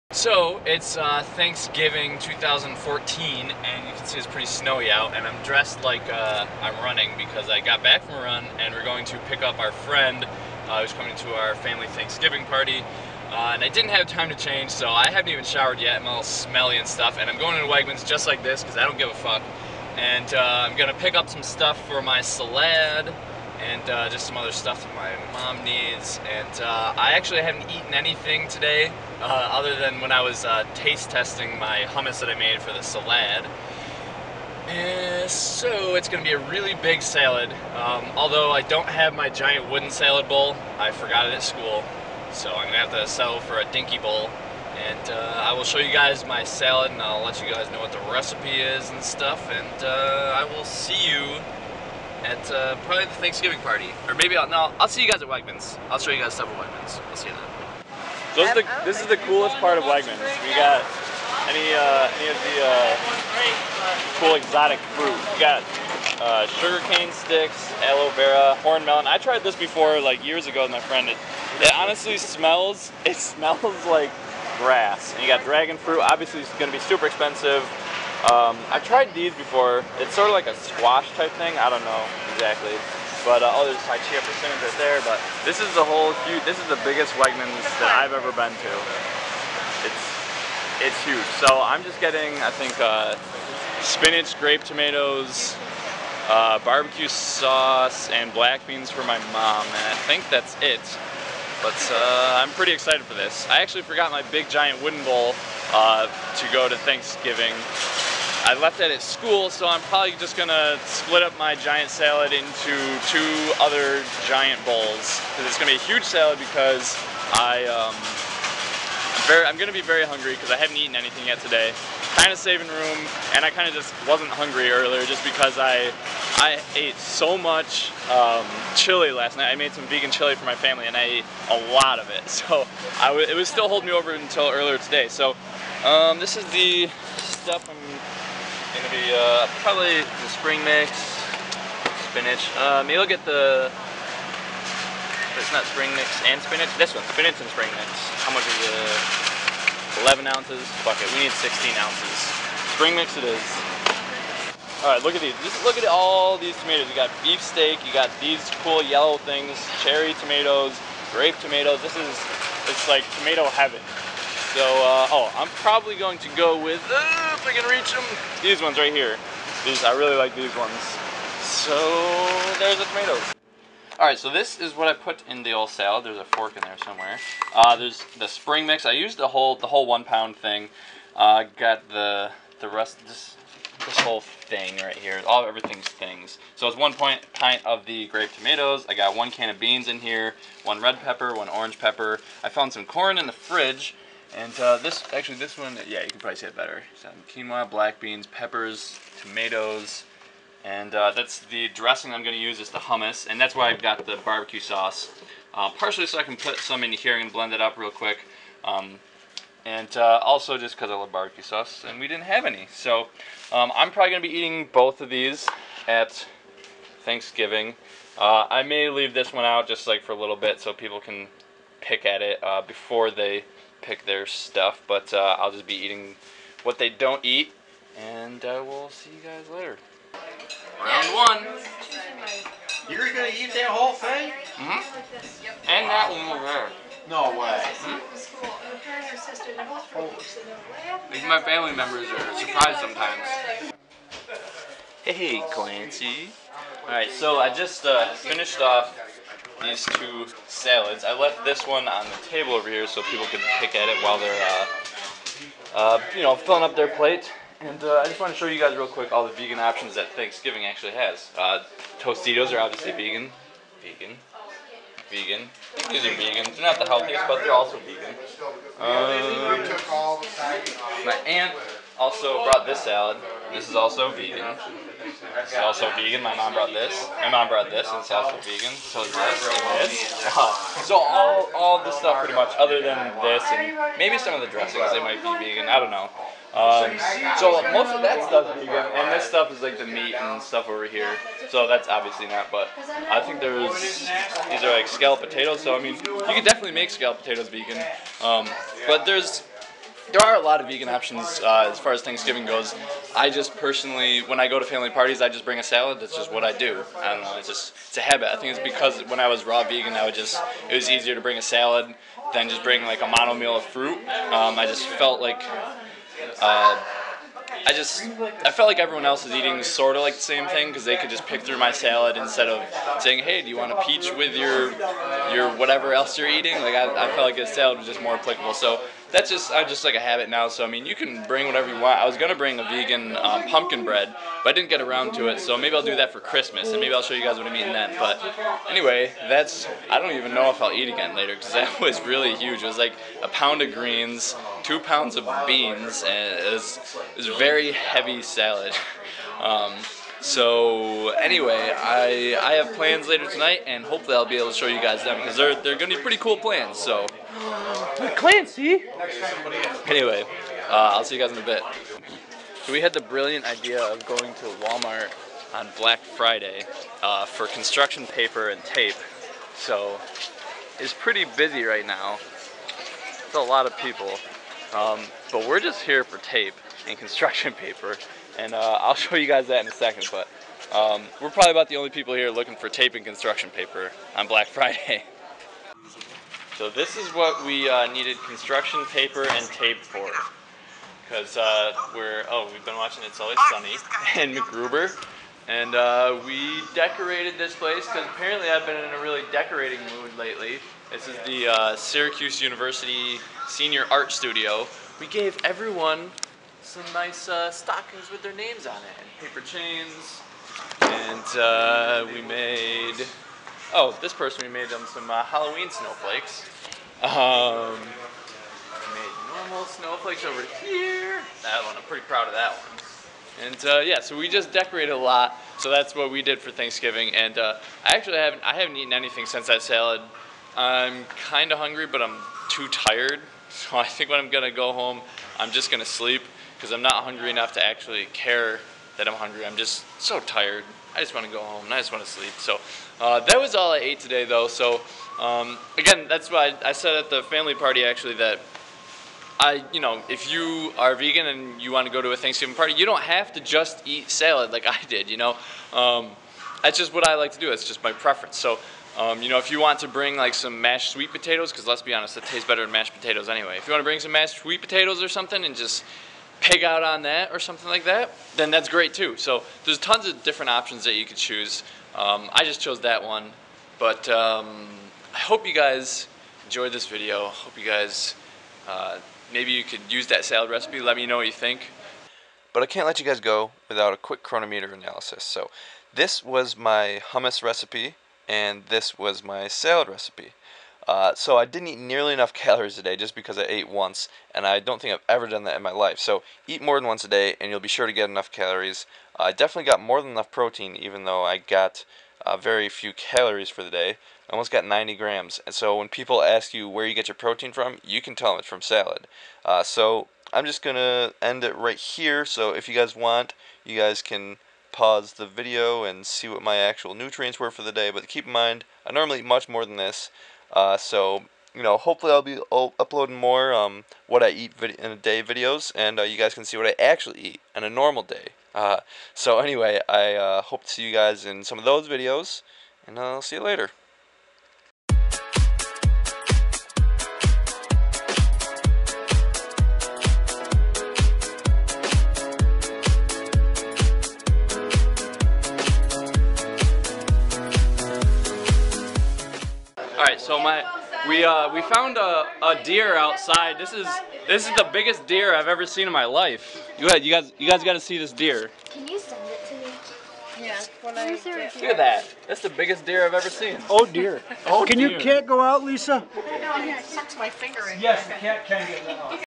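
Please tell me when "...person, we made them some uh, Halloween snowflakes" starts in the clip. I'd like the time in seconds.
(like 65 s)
414 s.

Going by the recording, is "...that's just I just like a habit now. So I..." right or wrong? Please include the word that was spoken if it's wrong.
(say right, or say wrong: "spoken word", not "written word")
right.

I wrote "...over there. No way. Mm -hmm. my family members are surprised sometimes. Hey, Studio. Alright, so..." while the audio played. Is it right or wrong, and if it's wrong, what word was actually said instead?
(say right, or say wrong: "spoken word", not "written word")
wrong: "Clancy", not "Studio".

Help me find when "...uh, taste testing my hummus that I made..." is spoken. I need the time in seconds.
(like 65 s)
30 s.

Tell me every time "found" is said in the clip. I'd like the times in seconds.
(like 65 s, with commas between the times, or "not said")
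192 s, 551 s.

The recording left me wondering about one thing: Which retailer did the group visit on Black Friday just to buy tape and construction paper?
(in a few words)
Walmart.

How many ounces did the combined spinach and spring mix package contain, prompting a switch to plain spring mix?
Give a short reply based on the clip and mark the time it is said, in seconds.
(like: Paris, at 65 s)
11 ounces, at 150 s.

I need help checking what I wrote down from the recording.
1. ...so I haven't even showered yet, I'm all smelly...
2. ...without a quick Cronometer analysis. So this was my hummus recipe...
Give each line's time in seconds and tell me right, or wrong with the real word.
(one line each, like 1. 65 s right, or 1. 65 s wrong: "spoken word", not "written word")
1. 14 s right
2. 483 s right.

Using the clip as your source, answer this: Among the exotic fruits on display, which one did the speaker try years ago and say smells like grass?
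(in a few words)
Horn melon.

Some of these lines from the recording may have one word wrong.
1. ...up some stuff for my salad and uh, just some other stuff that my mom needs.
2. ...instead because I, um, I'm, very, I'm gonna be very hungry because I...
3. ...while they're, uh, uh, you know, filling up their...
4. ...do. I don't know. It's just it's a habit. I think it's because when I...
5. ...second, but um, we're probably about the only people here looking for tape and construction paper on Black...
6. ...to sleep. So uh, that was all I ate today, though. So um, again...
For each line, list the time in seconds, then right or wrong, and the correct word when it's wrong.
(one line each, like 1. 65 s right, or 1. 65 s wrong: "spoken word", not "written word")
1. 21 s right
2. 116 s wrong: "salad", not "instead"
3. 254 s right
4. 306 s right
5. 379 s right
6. 442 s right.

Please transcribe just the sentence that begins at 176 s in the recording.
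There's a fork in there somewhere.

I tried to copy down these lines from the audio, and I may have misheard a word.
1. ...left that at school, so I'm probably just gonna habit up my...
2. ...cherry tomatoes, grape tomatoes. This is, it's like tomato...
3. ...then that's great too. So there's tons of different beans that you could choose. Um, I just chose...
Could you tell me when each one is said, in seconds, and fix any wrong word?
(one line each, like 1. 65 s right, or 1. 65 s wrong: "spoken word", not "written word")
1. 108 s wrong: "split", not "habit"
2. 159 s right
3. 468 s wrong: "options", not "beans".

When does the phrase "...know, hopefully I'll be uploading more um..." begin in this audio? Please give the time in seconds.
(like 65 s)
521 s.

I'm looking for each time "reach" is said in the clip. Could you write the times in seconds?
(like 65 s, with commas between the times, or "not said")
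167 s.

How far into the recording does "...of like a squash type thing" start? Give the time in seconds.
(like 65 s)
80 s.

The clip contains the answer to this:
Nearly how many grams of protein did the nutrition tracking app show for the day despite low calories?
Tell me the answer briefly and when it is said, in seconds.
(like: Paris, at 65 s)
90 grams, at 504 s.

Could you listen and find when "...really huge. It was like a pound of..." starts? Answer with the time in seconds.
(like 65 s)
342 s.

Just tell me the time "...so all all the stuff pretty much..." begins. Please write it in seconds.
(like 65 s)
280 s.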